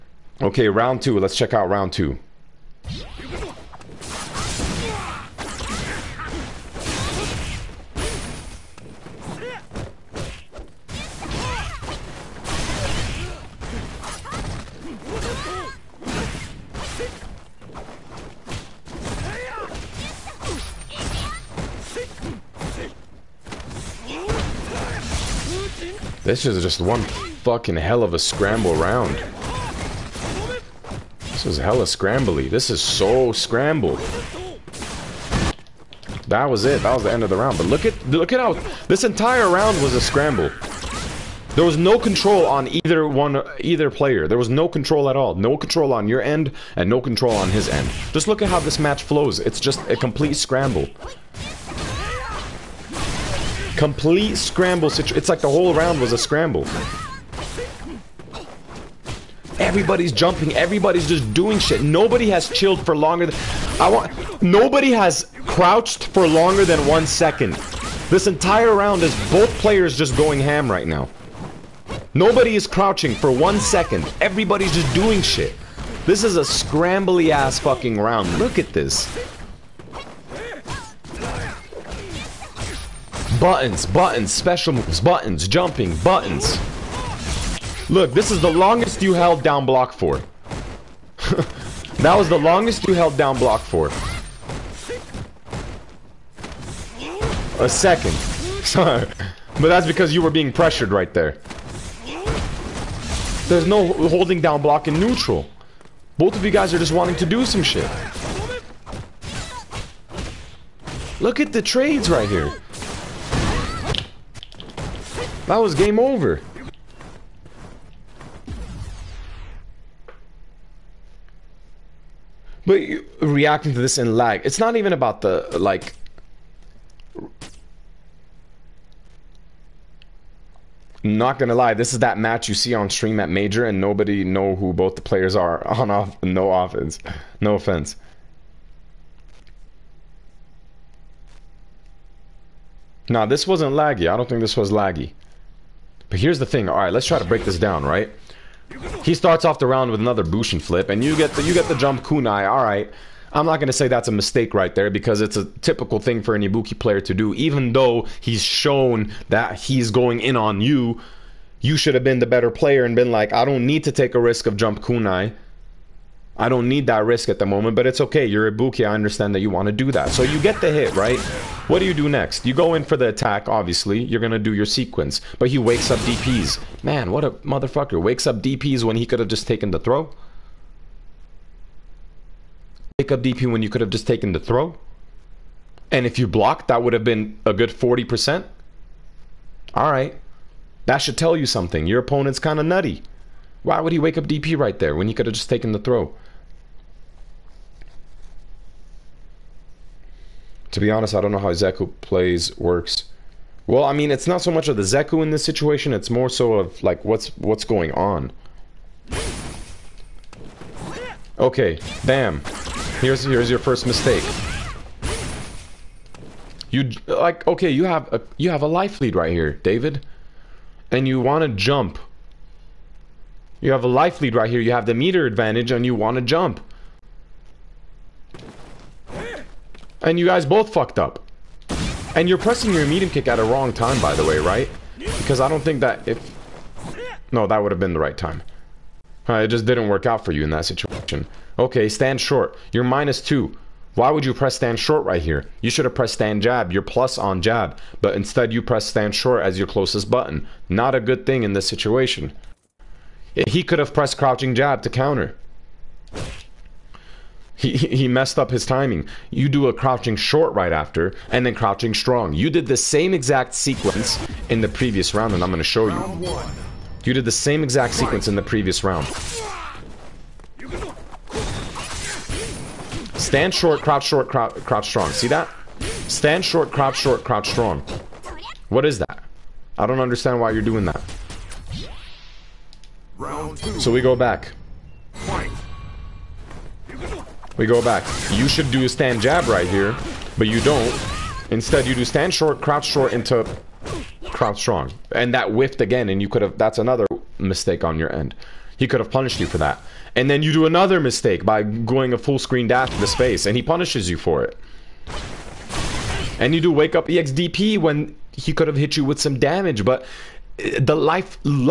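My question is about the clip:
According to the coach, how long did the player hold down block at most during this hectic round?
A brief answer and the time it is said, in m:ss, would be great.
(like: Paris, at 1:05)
1 second, at 1:37.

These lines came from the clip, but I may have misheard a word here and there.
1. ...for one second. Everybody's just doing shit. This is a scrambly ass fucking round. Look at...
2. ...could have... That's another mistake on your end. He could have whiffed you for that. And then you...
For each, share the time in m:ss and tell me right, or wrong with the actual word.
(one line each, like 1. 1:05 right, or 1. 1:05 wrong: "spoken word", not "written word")
1. 1:13 right
2. 4:56 wrong: "punished", not "whiffed".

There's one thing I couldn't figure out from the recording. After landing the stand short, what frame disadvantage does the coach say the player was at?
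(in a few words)
minus 2.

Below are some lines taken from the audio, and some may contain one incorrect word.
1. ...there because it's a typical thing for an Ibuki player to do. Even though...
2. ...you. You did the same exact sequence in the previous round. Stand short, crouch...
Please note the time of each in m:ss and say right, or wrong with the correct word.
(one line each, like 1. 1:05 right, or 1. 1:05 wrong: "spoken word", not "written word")
1. 2:34 right
2. 4:25 right.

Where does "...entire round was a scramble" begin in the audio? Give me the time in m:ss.
0:39.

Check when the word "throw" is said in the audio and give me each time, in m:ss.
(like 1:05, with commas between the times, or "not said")
2:59, 3:04, 3:15.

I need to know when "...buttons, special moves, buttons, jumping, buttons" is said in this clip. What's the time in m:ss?
1:23.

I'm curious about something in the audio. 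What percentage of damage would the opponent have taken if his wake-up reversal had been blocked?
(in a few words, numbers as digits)
40%.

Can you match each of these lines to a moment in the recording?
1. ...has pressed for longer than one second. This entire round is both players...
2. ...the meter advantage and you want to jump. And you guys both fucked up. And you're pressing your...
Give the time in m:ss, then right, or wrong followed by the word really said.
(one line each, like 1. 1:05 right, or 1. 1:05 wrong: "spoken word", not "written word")
1. 1:04 wrong: "crouched", not "pressed"
2. 3:44 right.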